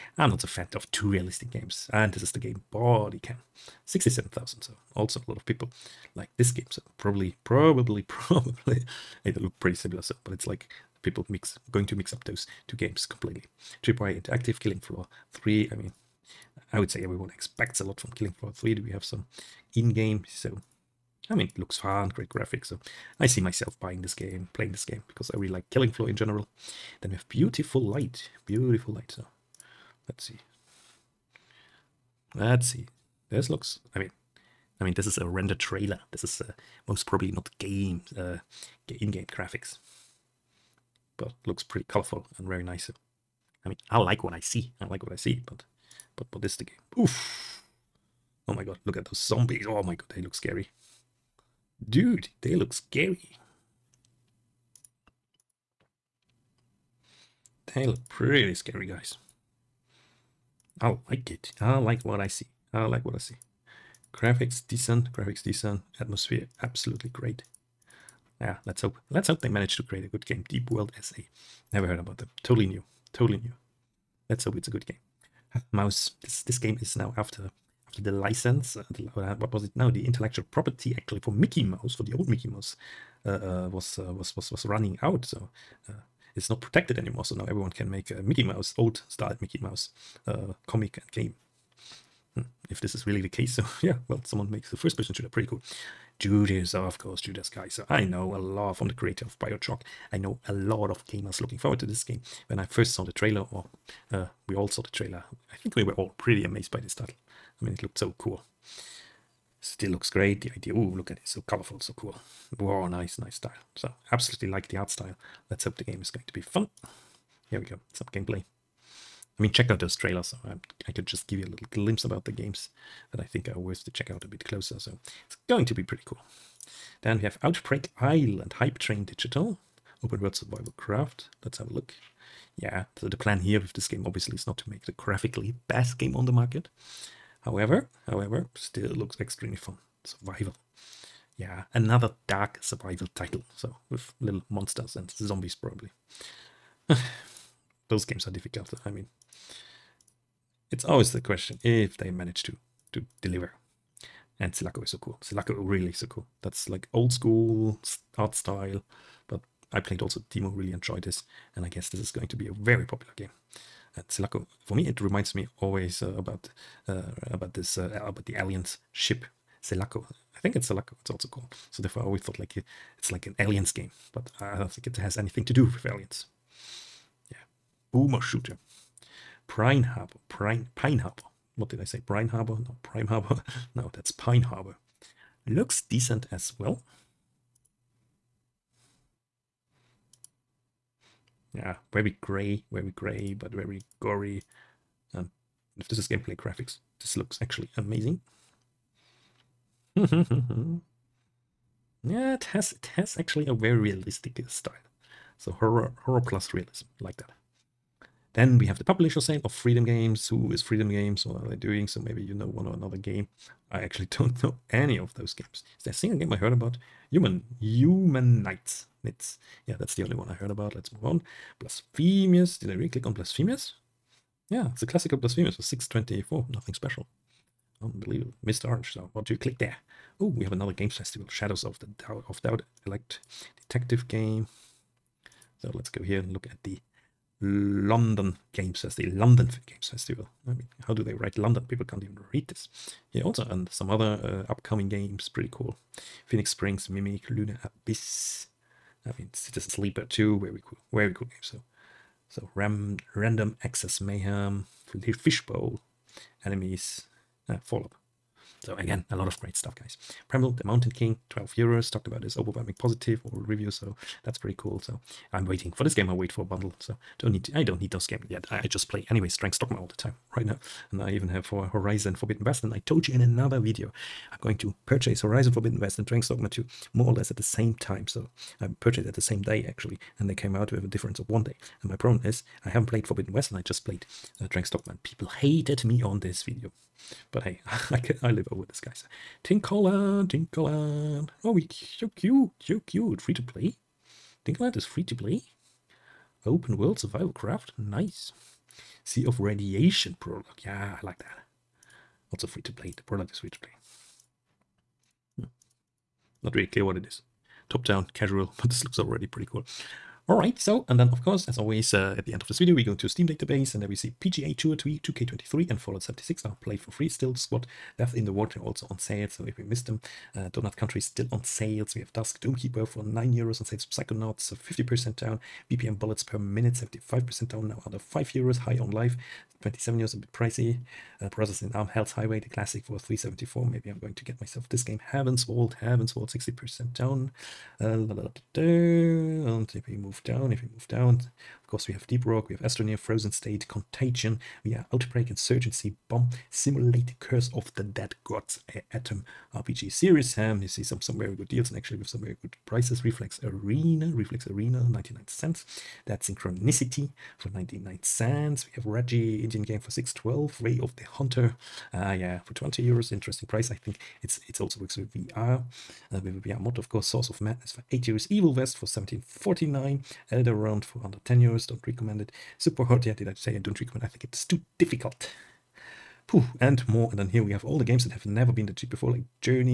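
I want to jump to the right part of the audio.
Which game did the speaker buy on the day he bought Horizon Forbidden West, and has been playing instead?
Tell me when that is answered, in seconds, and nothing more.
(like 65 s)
276 s.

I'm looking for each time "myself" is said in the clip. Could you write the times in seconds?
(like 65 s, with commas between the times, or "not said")
23 s, 334 s.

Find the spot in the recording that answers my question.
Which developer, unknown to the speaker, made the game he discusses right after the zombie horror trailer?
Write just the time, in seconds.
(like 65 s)
70 s.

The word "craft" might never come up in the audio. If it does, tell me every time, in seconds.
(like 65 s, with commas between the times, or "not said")
130 s, 297 s.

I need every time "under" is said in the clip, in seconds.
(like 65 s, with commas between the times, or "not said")
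327 s, 371 s.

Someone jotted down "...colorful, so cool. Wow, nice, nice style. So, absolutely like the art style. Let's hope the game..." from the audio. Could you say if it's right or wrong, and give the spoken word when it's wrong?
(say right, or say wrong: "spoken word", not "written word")
right.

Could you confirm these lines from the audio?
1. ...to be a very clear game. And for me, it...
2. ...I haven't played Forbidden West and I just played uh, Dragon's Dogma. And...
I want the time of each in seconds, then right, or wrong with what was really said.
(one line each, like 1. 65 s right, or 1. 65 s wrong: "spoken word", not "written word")
1. 162 s wrong: "popular", not "clear"
2. 282 s right.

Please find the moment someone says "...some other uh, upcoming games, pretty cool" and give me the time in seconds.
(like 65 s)
243 s.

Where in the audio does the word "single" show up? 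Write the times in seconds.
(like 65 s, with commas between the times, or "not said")
215 s.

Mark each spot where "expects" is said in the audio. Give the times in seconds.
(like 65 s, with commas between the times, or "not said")
17 s.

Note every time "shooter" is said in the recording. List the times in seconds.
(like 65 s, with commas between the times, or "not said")
95 s, 178 s.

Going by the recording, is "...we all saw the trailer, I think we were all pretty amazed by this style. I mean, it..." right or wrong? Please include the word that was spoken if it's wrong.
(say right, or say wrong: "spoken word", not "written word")
wrong: "title", not "style".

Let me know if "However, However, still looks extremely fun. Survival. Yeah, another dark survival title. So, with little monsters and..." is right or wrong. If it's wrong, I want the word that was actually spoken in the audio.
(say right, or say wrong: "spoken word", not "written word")
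right.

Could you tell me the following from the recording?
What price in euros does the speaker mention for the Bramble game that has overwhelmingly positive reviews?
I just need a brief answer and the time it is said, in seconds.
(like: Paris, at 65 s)
12 euros, at 261 s.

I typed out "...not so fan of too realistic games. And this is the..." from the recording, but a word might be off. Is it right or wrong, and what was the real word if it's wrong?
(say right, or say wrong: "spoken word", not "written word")
right.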